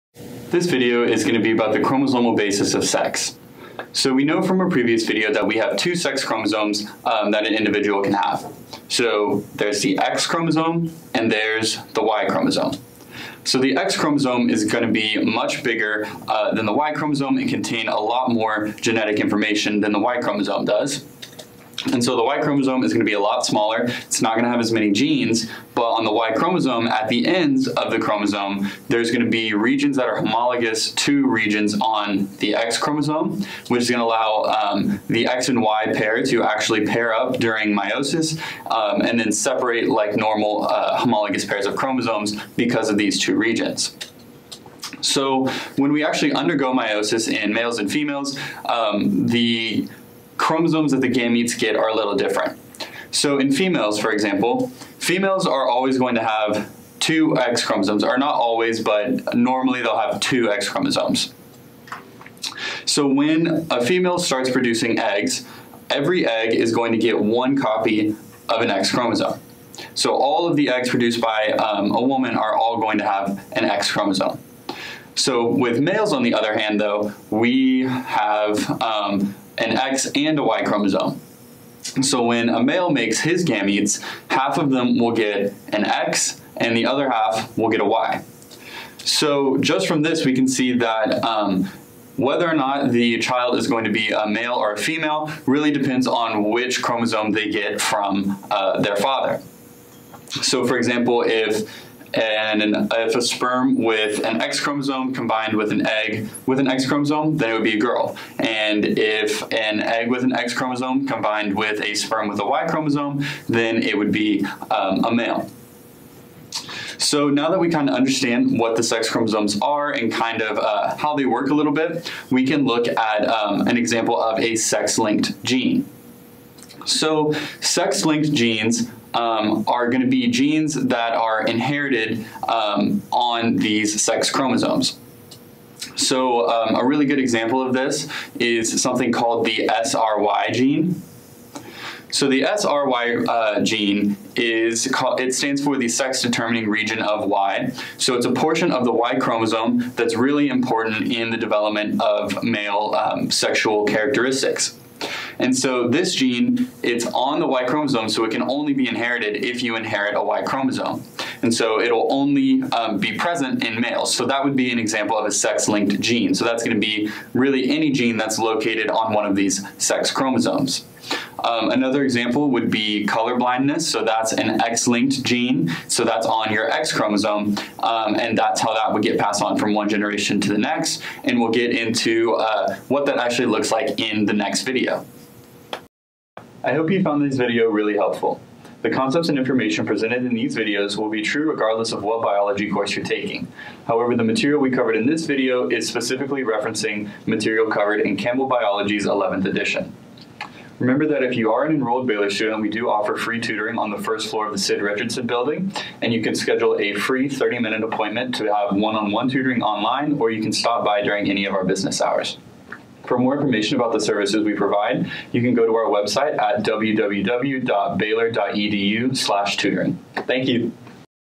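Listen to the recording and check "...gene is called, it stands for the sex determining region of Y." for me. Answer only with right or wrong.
right.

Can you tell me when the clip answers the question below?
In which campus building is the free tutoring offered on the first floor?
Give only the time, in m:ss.
3:24.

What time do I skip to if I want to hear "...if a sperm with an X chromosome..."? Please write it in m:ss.
1:42.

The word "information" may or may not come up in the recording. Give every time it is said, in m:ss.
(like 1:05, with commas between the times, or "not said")
0:19, 3:09, 3:33.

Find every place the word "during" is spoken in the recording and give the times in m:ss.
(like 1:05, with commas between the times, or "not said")
0:37, 3:31.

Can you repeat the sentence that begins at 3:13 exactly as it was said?
However, the material we covered in this video is specifically referencing material covered in Campbell Biology's 11th edition.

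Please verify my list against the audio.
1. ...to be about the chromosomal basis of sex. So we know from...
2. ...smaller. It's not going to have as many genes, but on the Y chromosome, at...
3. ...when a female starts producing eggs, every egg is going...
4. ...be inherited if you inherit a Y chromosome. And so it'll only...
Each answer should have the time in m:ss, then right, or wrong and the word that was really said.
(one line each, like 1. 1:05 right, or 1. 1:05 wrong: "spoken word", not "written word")
1. 0:01 right
2. 0:23 right
3. 1:03 right
4. 2:38 right.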